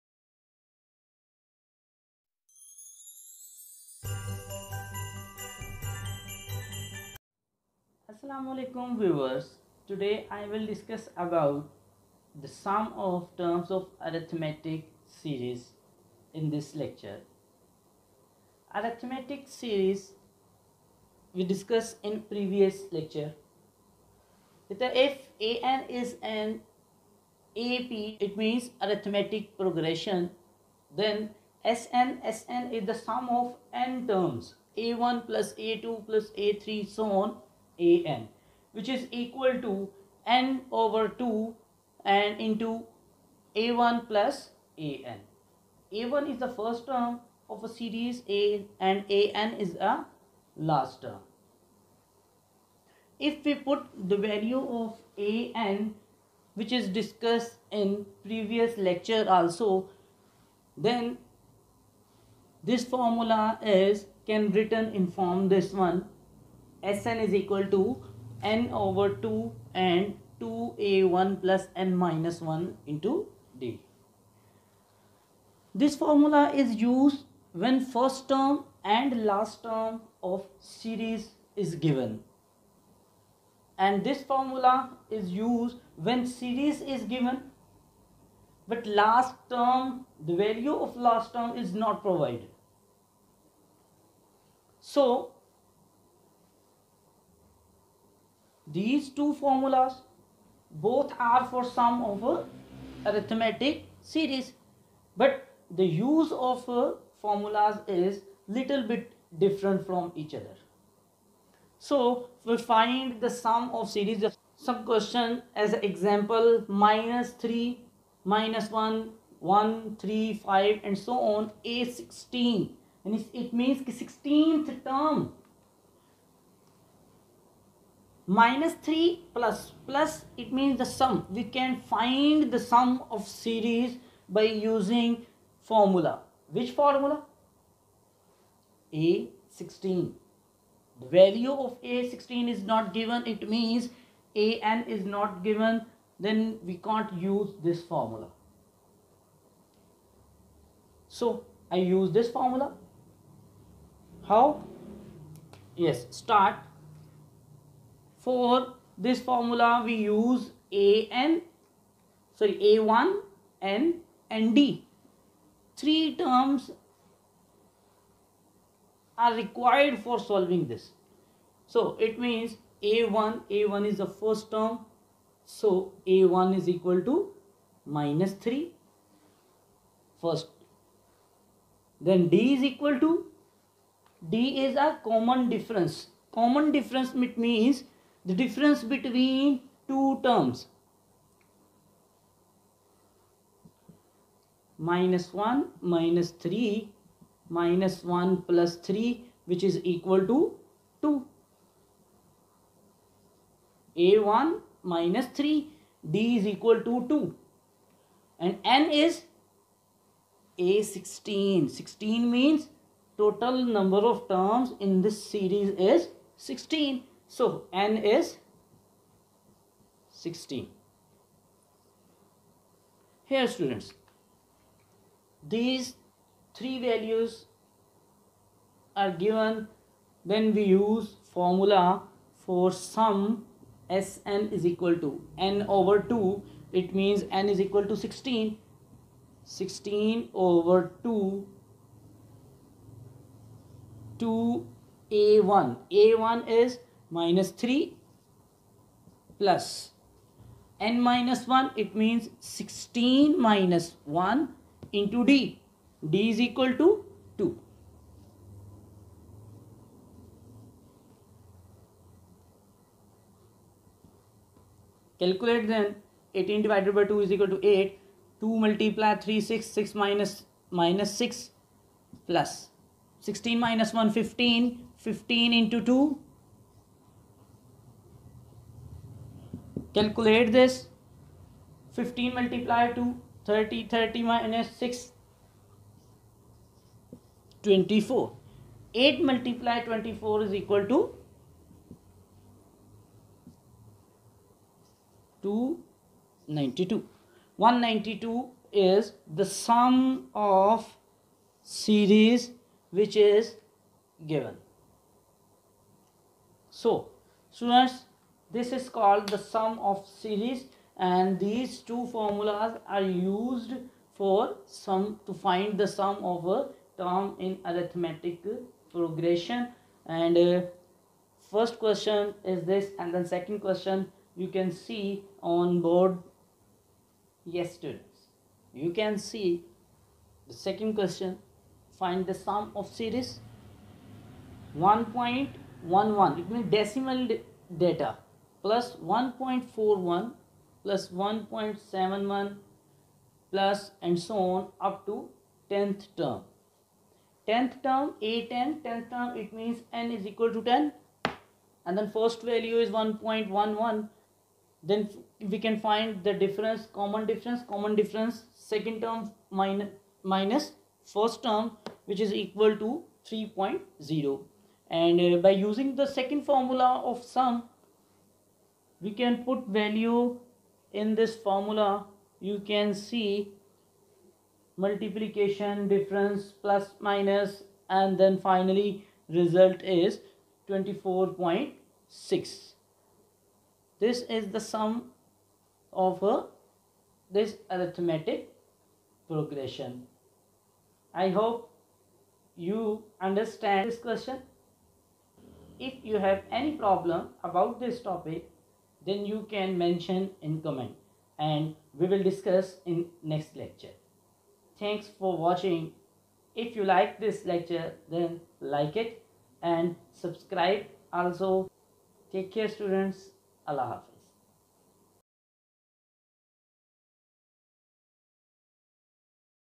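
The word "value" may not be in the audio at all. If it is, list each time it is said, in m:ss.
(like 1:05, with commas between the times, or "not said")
0:54, 1:30, 2:21, 3:46, 5:52, 6:09.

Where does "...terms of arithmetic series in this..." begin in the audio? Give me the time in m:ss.
0:13.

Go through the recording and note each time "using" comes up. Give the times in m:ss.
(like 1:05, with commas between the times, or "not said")
2:14, 6:05.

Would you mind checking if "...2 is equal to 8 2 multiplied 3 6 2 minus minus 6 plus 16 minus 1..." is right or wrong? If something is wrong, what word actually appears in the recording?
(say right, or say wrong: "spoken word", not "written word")
wrong: "6", not "2".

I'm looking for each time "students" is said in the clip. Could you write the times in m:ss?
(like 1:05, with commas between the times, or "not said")
3:43, 5:07, 5:27, 6:52.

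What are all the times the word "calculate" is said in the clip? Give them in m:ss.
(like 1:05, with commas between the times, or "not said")
4:25, 4:39.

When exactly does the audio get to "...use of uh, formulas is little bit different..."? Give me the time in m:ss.
1:45.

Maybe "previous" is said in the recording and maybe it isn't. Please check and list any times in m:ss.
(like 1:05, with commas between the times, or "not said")
0:22, 0:58.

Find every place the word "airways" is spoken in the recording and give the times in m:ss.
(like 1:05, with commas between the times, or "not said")
not said.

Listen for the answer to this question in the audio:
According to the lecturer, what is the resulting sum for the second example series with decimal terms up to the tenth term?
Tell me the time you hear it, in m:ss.
6:20.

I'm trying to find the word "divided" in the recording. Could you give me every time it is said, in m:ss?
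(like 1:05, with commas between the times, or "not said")
4:26.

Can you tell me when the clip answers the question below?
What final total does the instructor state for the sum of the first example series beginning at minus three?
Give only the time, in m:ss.
4:57.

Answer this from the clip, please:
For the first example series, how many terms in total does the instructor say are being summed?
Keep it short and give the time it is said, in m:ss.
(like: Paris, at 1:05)
16, at 3:33.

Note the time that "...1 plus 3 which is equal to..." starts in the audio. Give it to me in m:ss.
3:18.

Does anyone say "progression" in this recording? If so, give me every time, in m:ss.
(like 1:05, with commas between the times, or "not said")
0:29, 5:18, 6:29.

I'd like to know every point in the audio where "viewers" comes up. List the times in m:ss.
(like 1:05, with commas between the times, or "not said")
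0:08.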